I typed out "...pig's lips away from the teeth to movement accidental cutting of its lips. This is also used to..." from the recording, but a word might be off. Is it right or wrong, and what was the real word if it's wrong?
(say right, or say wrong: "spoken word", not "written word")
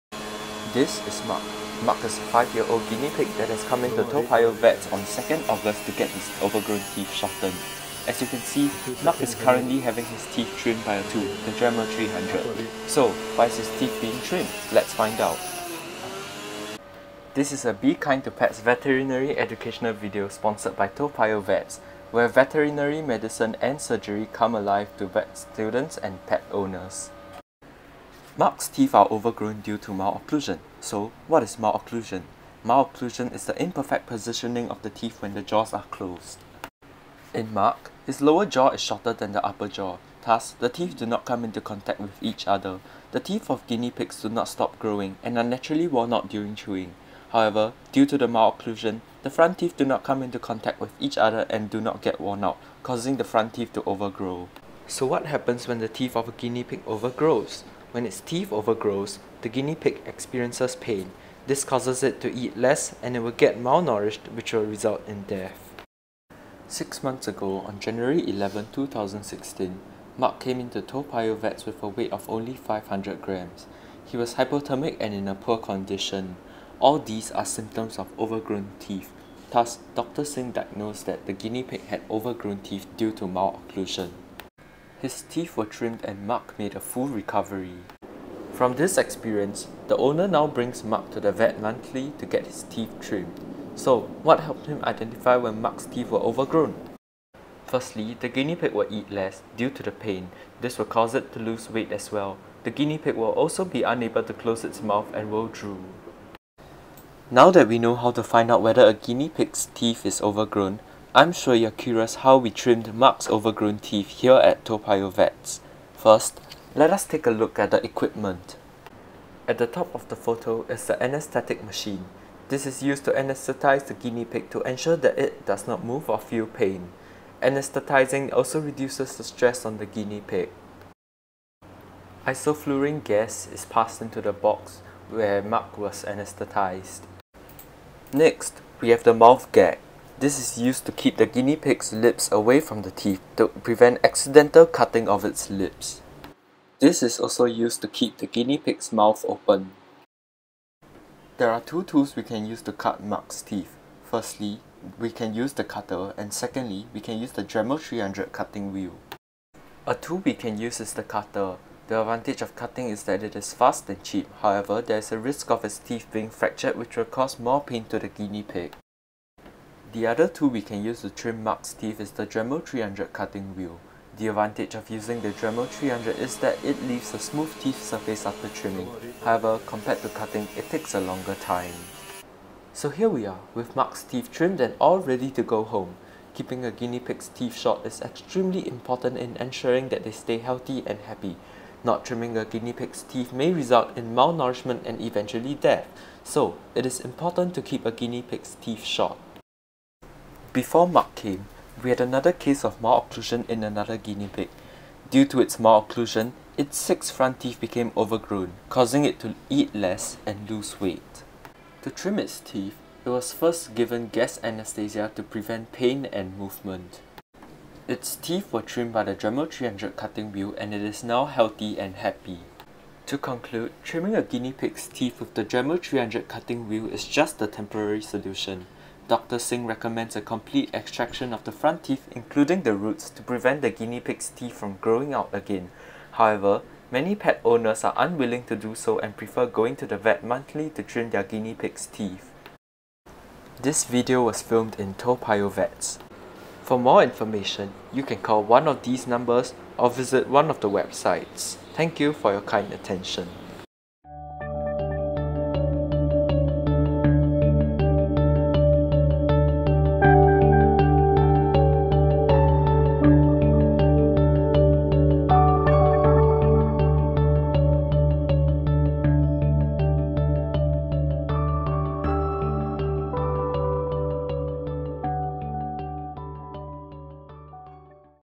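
wrong: "prevent", not "movement".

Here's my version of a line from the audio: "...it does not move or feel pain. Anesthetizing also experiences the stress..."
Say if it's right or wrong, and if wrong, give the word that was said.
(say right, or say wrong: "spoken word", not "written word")
wrong: "reduces", not "experiences".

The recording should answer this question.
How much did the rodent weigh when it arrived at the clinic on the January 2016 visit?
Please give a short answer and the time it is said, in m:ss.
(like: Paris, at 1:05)
500 grams, at 1:12.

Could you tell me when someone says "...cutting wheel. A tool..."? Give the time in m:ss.
2:38.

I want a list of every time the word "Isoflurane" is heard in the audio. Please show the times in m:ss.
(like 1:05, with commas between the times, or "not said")
2:12.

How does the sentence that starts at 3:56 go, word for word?
However, many pet owners are unwilling to do so and prefer going to the vet monthly to trim their guinea pig's teeth.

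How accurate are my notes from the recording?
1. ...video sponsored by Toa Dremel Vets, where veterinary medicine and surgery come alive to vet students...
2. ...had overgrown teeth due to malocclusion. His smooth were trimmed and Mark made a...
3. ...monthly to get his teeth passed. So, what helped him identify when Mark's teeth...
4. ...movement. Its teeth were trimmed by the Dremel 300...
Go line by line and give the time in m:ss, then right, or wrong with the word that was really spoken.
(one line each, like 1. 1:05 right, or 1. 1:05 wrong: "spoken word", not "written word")
1. 0:19 wrong: "Payoh", not "Dremel"
2. 1:21 wrong: "teeth", not "smooth"
3. 1:31 wrong: "trimmed", not "passed"
4. 3:36 right.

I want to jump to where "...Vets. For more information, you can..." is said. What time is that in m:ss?
4:05.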